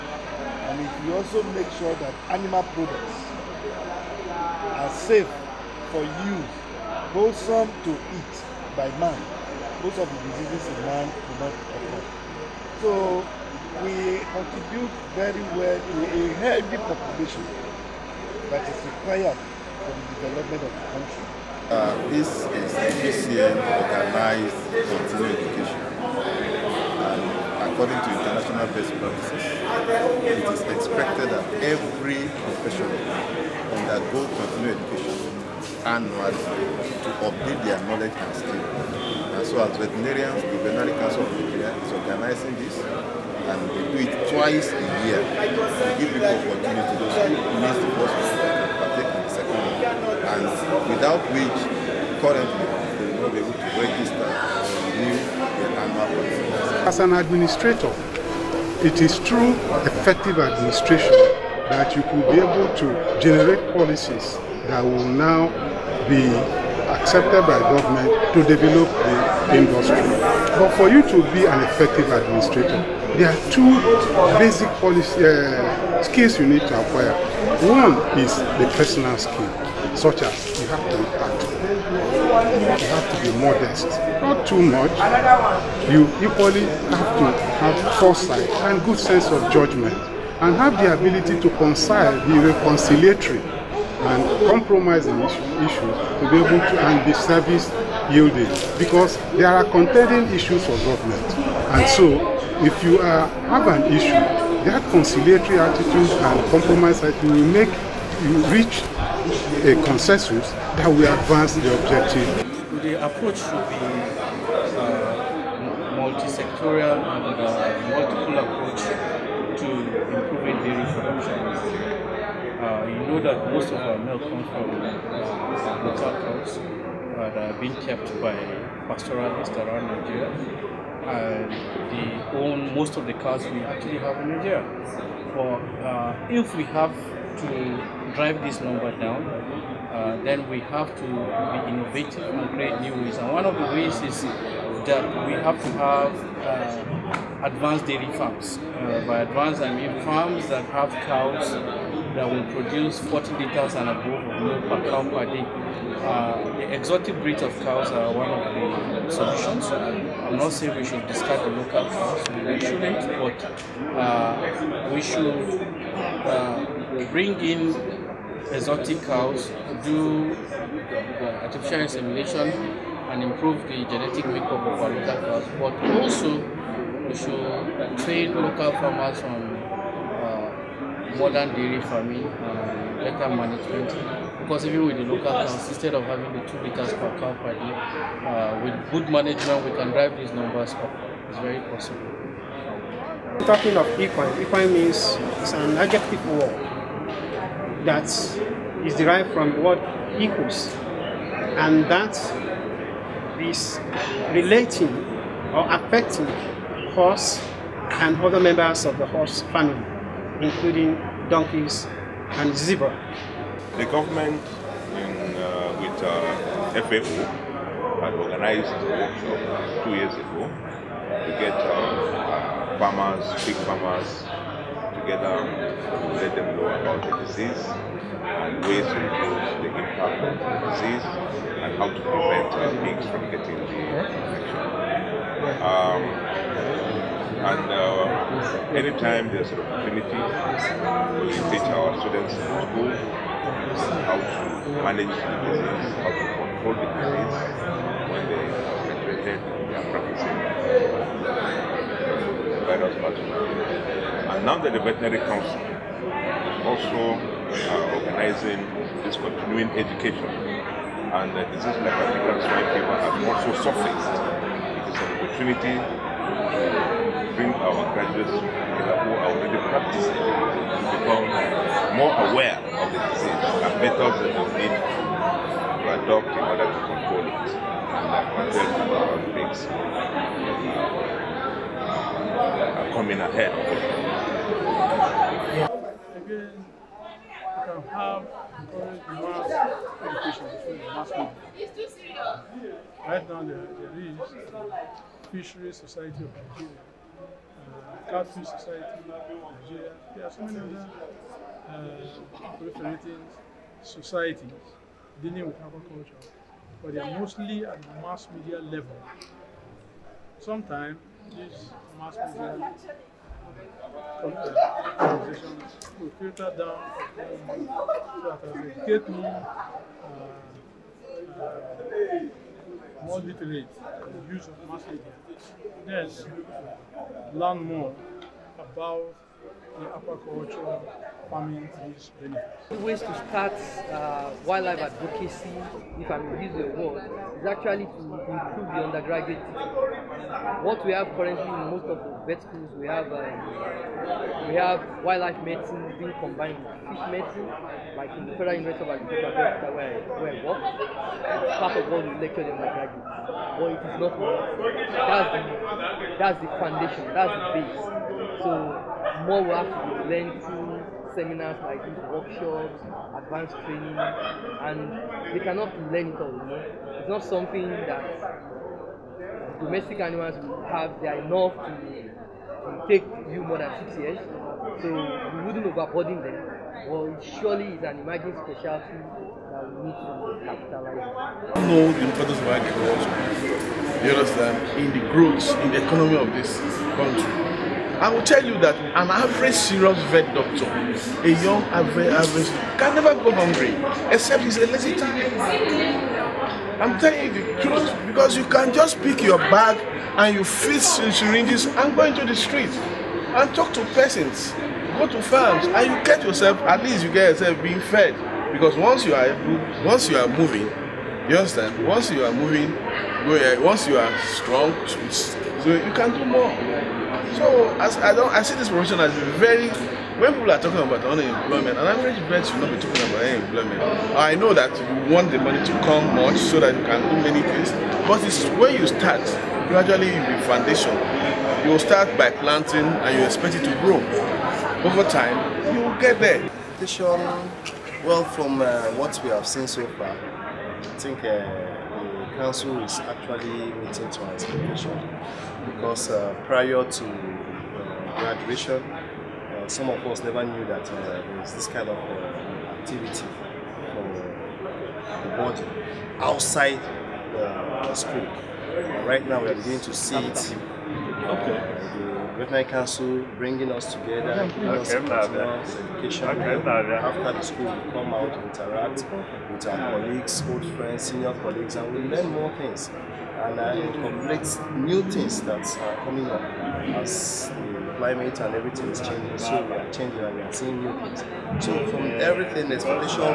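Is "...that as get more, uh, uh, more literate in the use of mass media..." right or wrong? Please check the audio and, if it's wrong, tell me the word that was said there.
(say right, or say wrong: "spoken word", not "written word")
right.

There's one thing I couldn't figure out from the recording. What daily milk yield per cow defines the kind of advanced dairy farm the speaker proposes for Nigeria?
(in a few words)
40 liters and above.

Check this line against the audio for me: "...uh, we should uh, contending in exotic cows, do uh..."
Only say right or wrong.
wrong.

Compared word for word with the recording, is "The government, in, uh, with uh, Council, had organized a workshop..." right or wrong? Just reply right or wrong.
wrong.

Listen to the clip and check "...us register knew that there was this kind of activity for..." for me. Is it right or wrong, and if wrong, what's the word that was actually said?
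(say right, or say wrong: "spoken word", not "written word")
wrong: "never", not "register".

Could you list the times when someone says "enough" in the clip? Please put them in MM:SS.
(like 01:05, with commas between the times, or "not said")
05:54, 06:11.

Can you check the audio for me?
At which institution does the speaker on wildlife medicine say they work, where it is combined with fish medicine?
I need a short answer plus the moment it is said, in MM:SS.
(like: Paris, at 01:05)
Federal University of Agriculture, at 05:48.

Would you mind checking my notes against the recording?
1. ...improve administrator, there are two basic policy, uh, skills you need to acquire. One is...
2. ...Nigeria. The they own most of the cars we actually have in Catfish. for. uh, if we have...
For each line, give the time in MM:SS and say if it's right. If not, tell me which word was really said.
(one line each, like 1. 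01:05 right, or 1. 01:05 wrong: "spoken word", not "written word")
1. 01:11 wrong: "effective", not "improve"
2. 02:09 wrong: "Nigeria", not "Catfish".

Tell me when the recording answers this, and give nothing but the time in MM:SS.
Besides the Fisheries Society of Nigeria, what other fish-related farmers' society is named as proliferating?
04:58.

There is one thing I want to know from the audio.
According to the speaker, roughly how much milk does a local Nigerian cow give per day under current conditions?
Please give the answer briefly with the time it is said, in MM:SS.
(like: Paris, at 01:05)
2 liters, at 03:06.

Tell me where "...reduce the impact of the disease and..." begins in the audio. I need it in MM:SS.
03:48.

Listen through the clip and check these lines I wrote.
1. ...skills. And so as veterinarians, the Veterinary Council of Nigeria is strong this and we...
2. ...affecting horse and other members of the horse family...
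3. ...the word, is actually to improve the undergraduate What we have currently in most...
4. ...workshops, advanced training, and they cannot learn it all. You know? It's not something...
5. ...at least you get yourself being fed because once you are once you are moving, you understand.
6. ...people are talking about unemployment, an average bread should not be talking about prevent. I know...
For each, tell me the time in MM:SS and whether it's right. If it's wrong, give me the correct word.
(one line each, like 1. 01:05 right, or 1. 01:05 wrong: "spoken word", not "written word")
1. 00:38 wrong: "organizing", not "strong"
2. 03:25 right
3. 05:36 right
4. 06:02 right
5. 06:46 right
6. 07:00 wrong: "unemployment", not "prevent".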